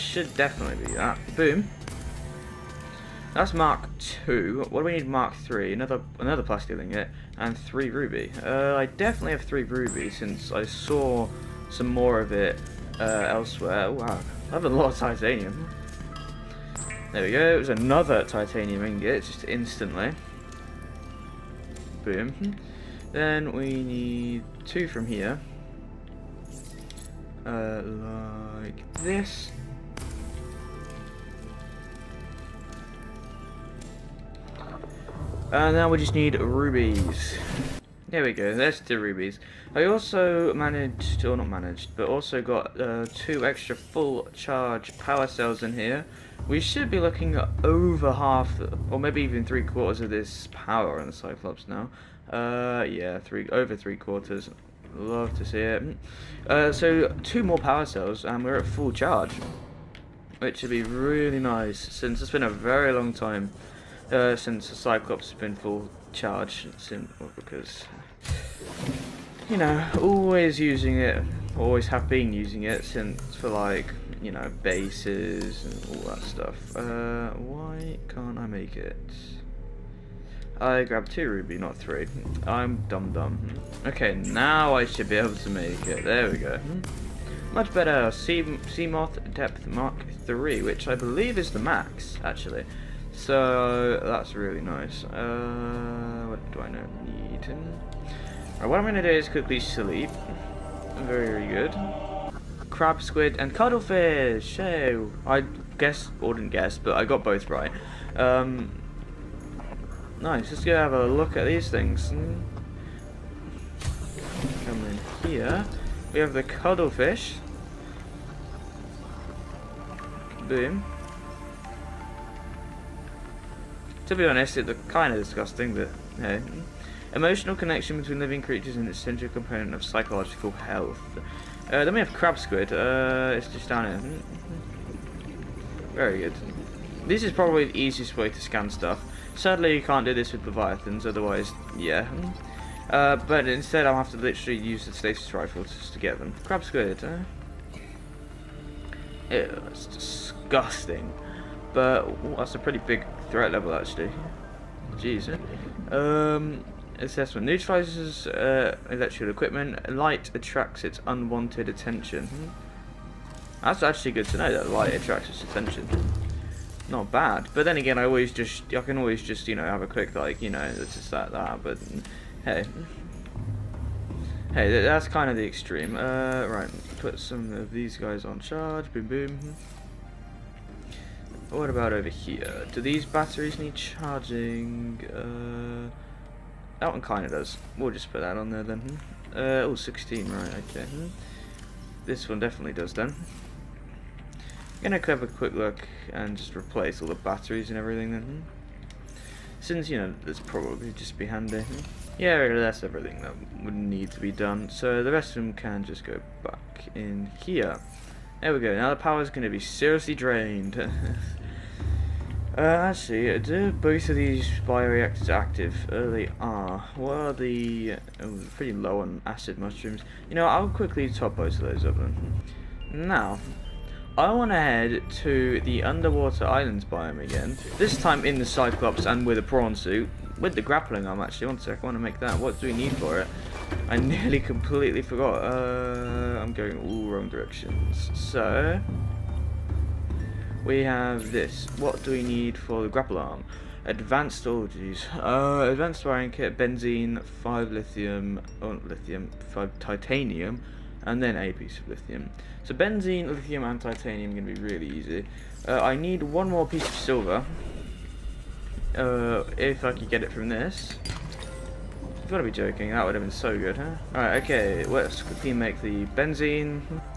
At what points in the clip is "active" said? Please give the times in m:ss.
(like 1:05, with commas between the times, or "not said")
3:35.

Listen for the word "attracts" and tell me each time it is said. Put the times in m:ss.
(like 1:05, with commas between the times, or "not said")
2:40, 2:44.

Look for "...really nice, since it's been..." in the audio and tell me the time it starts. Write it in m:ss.
1:00.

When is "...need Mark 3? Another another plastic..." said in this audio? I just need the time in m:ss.
0:04.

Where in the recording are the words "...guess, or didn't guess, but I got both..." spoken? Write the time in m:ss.
1:45.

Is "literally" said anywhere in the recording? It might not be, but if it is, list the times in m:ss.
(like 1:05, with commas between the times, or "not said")
2:24.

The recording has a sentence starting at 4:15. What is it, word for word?
Uh, I need one more piece of silver.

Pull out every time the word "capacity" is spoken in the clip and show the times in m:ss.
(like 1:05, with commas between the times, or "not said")
not said.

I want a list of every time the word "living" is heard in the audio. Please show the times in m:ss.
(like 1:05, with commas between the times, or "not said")
2:08.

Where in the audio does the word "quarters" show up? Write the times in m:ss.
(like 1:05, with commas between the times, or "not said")
0:49, 0:53.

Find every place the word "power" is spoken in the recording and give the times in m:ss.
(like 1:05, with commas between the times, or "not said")
0:44, 0:50, 0:57, 3:28.